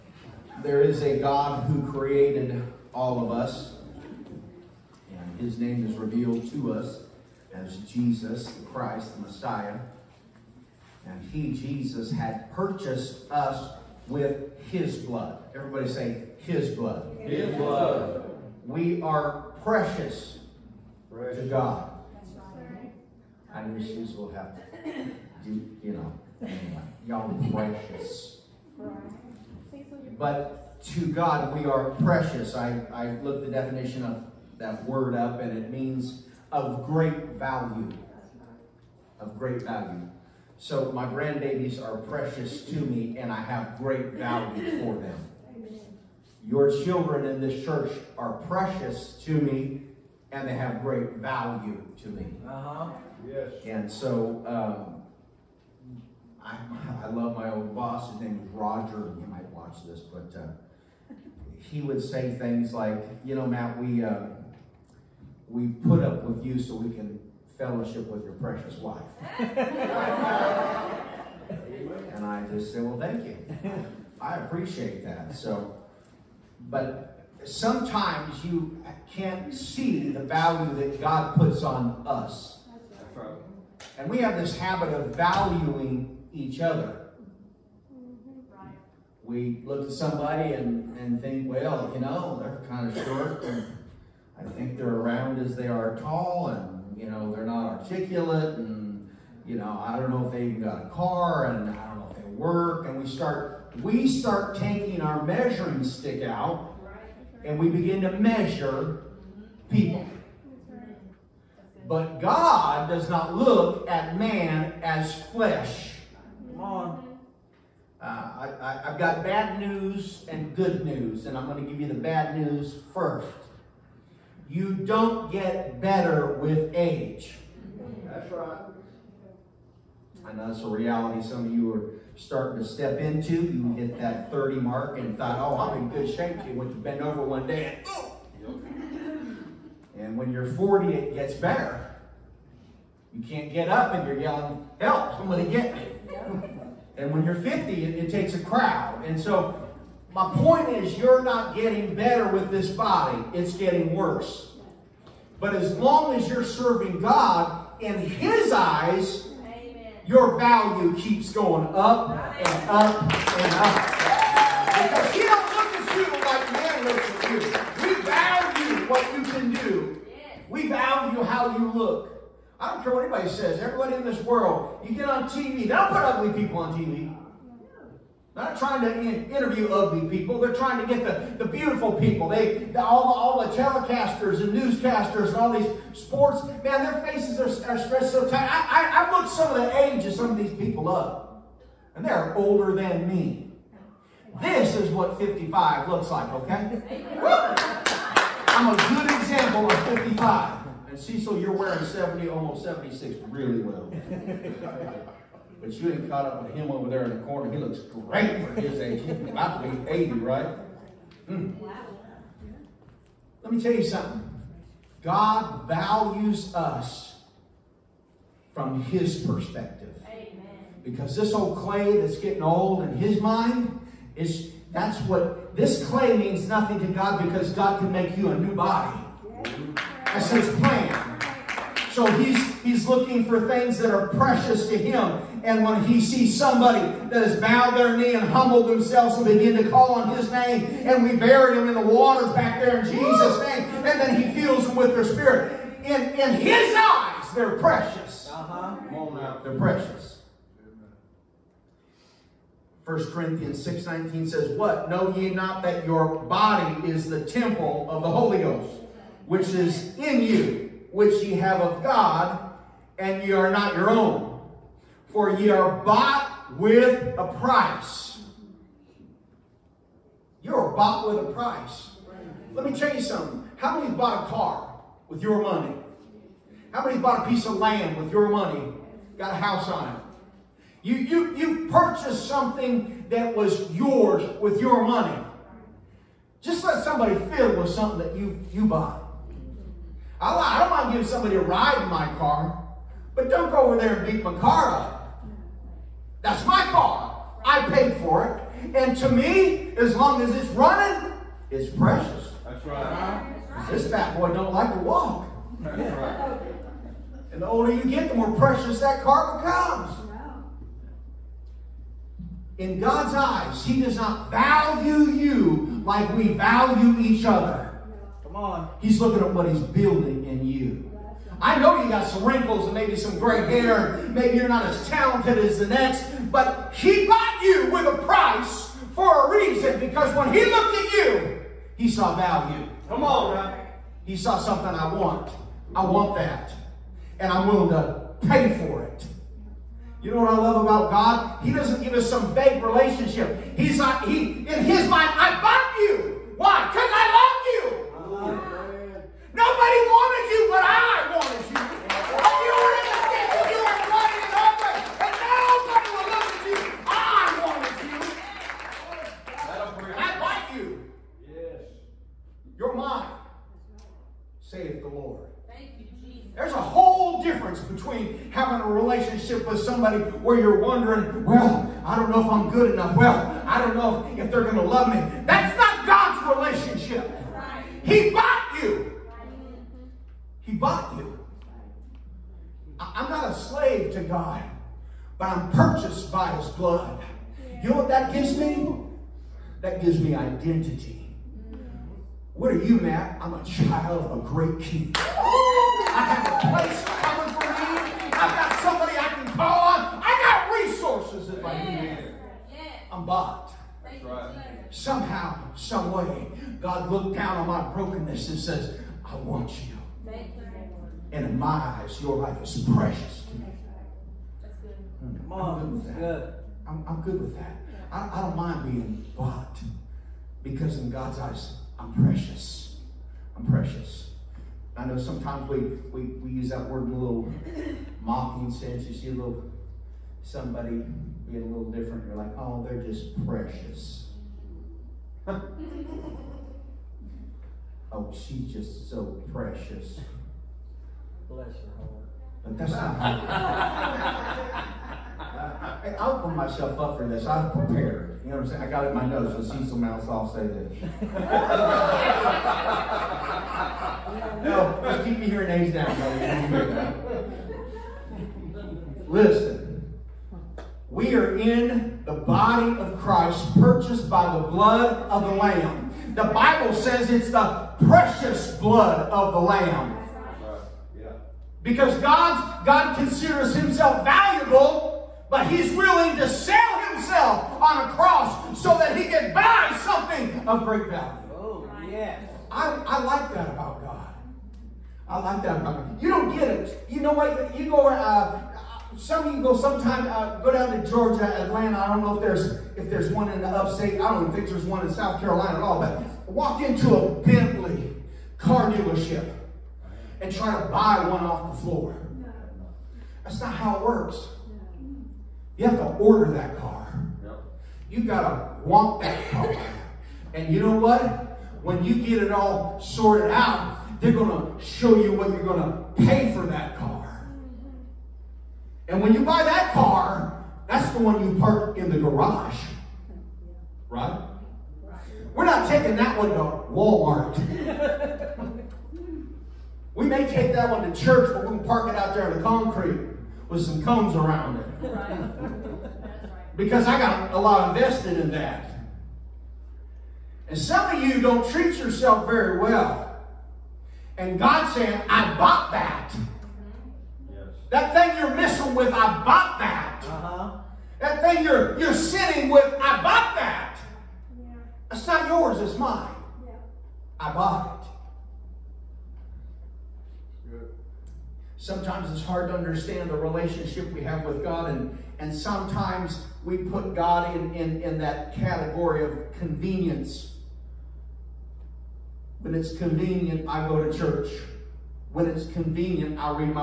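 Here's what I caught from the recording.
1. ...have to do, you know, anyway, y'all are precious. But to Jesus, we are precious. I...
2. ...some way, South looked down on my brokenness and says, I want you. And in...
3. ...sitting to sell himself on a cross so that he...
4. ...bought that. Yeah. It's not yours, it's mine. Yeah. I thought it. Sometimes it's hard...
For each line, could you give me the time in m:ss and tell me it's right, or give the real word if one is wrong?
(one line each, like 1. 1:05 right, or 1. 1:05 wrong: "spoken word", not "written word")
1. 0:24 wrong: "God", not "Jesus"
2. 6:45 wrong: "God", not "South"
3. 7:55 wrong: "willing", not "sitting"
4. 9:13 wrong: "bought", not "thought".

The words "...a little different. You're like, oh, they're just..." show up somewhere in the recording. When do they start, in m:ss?
7:11.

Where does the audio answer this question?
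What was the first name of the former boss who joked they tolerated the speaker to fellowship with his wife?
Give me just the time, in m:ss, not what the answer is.
0:58.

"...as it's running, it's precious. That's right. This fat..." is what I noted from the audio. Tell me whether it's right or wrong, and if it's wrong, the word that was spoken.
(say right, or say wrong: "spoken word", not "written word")
right.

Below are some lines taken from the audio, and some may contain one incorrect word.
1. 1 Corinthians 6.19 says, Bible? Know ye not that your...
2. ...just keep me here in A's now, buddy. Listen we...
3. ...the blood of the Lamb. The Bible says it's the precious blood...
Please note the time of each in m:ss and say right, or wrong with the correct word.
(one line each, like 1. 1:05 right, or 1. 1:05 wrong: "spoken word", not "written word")
1. 4:12 wrong: "What", not "Bible"
2. 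7:34 right
3. 7:44 right.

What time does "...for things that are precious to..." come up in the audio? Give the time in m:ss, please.
3:53.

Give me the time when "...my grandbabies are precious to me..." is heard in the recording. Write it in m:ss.
0:40.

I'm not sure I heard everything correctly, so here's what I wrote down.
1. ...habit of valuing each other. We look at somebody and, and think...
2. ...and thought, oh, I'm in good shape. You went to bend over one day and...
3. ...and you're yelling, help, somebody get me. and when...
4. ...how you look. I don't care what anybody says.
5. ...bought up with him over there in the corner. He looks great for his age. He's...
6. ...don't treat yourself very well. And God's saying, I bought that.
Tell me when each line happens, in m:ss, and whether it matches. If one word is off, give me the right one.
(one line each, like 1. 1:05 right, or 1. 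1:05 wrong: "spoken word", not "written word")
1. 1:24 right
2. 2:14 right
3. 2:23 right
4. 2:51 right
5. 3:26 wrong: "caught", not "bought"
6. 9:01 right.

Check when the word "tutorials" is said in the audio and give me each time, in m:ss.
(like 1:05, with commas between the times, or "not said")
not said.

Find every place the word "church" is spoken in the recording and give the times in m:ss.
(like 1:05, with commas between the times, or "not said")
0:47, 8:51, 9:33.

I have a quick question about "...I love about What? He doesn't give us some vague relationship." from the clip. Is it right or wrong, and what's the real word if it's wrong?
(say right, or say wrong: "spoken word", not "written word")
wrong: "God", not "What".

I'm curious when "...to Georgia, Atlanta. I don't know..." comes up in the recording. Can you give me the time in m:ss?
8:10.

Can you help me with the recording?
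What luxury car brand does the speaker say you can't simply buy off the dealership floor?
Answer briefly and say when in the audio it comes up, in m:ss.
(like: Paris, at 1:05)
Bentley, at 8:17.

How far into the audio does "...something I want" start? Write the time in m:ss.
5:34.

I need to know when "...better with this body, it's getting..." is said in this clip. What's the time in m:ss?
2:31.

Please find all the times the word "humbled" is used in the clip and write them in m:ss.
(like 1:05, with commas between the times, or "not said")
3:58.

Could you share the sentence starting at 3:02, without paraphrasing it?
They, the, all, the, all the telecasters and newscasters and all these sports, man, their faces are, are stretched so tight.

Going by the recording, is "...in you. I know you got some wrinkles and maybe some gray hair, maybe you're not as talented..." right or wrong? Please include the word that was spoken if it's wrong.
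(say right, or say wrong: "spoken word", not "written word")
right.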